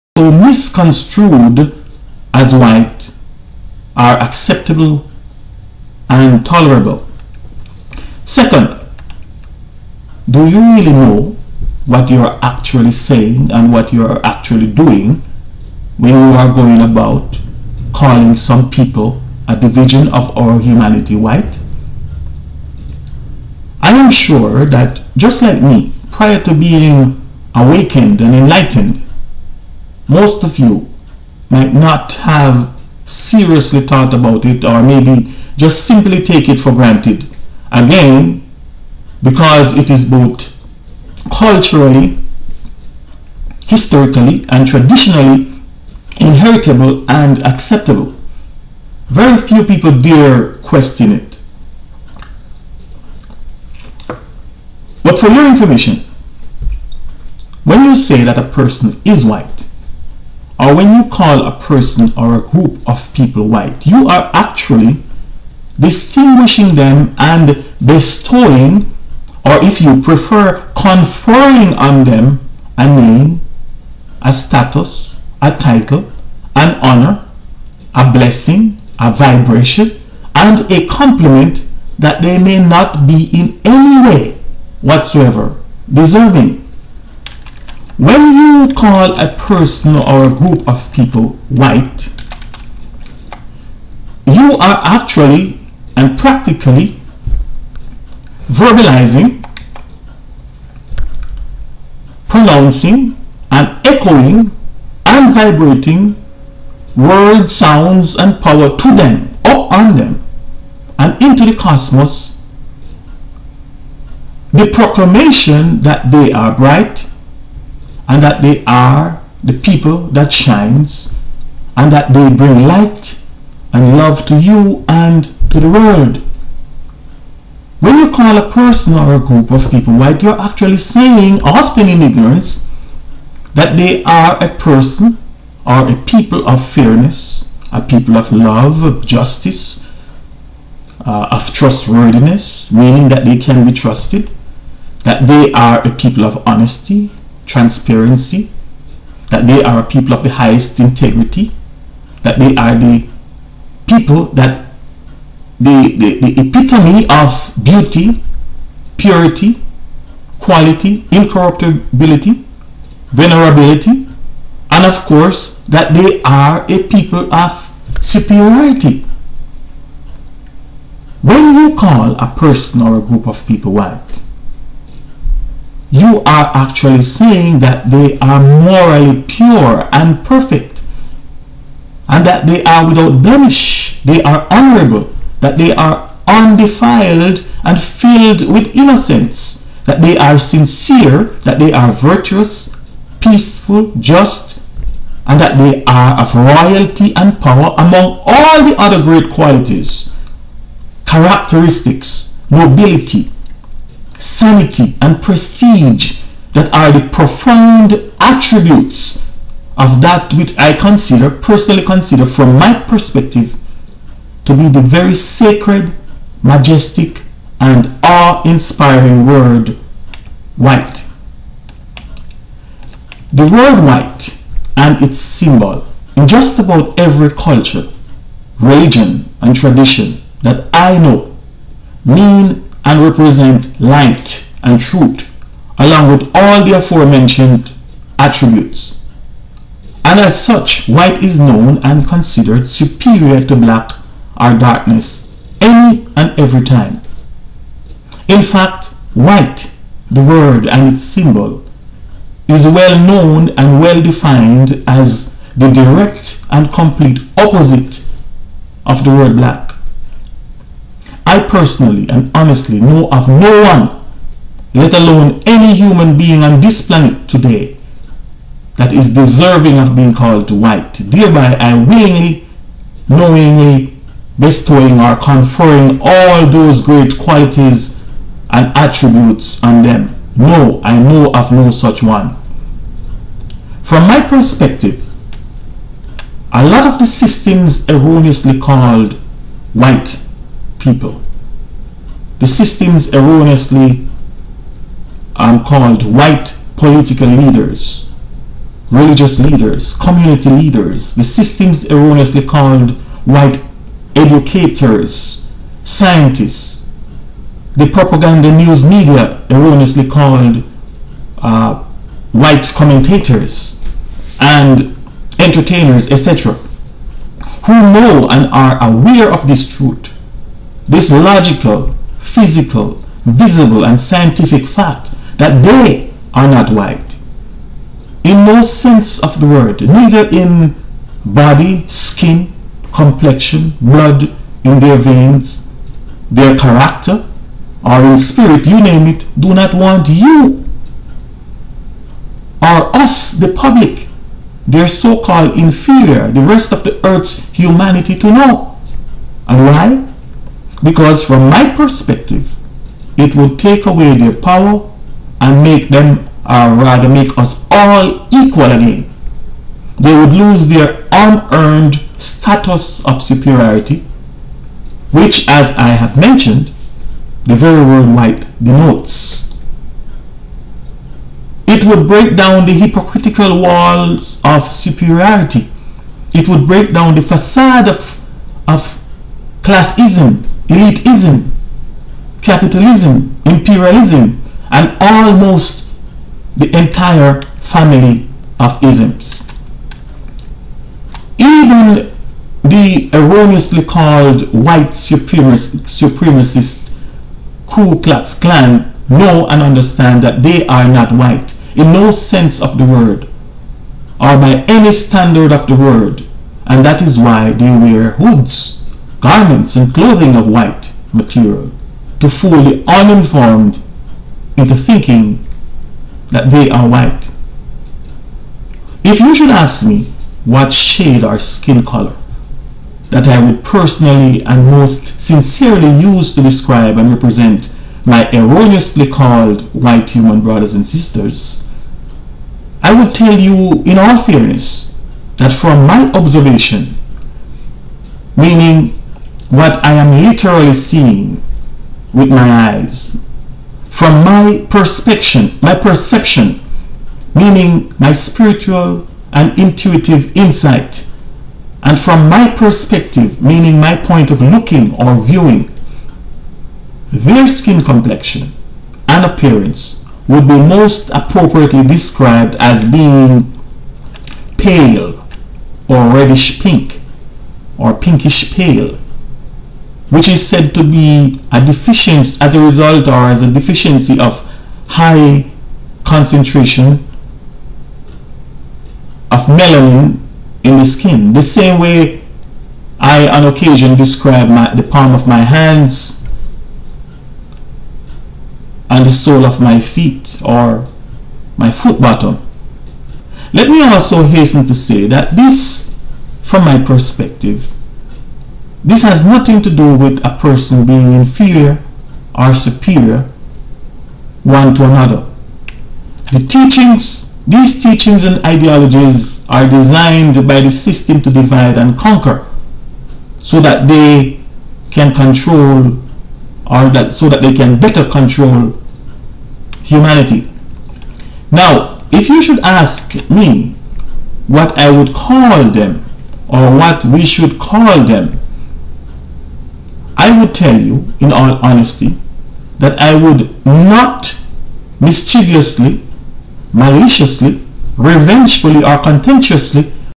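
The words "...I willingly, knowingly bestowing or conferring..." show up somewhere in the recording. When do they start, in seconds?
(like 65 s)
271 s.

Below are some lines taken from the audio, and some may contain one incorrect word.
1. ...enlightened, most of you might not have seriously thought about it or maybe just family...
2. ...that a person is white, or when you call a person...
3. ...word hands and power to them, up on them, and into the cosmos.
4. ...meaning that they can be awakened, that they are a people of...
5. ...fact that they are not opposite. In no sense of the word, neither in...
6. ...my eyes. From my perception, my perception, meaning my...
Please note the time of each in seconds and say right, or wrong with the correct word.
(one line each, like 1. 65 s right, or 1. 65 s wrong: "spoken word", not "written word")
1. 28 s wrong: "simply", not "family"
2. 58 s right
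3. 106 s wrong: "sounds", not "hands"
4. 142 s wrong: "trusted", not "awakened"
5. 324 s wrong: "white", not "opposite"
6. 442 s right.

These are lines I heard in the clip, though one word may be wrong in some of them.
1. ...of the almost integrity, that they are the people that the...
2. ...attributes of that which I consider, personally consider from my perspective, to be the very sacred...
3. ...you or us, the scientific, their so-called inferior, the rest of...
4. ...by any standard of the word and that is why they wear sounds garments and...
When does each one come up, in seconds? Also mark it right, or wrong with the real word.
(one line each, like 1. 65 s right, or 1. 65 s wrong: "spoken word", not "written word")
1. 150 s wrong: "highest", not "almost"
2. 208 s right
3. 340 s wrong: "public", not "scientific"
4. 404 s wrong: "hoods", not "sounds".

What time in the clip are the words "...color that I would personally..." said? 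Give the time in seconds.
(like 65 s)
421 s.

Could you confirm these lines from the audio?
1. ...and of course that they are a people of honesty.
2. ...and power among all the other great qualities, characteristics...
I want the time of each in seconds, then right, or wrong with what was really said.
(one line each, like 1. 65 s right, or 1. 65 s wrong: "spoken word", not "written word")
1. 164 s wrong: "superiority", not "honesty"
2. 197 s right.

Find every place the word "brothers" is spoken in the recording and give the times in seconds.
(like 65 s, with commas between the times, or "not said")
430 s.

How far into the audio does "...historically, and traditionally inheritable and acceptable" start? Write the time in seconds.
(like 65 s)
43 s.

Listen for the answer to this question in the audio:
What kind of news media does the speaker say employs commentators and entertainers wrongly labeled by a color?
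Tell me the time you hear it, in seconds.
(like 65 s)
307 s.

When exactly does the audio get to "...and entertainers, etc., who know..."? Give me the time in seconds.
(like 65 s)
314 s.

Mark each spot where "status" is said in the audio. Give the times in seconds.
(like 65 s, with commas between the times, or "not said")
74 s, 362 s.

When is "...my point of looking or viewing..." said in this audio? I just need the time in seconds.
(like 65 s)
453 s.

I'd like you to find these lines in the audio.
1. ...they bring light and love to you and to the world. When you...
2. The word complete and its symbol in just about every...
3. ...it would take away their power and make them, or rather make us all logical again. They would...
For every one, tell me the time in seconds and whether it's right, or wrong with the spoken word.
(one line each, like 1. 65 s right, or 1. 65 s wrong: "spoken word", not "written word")
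1. 122 s right
2. 223 s wrong: "white", not "complete"
3. 353 s wrong: "equal", not "logical".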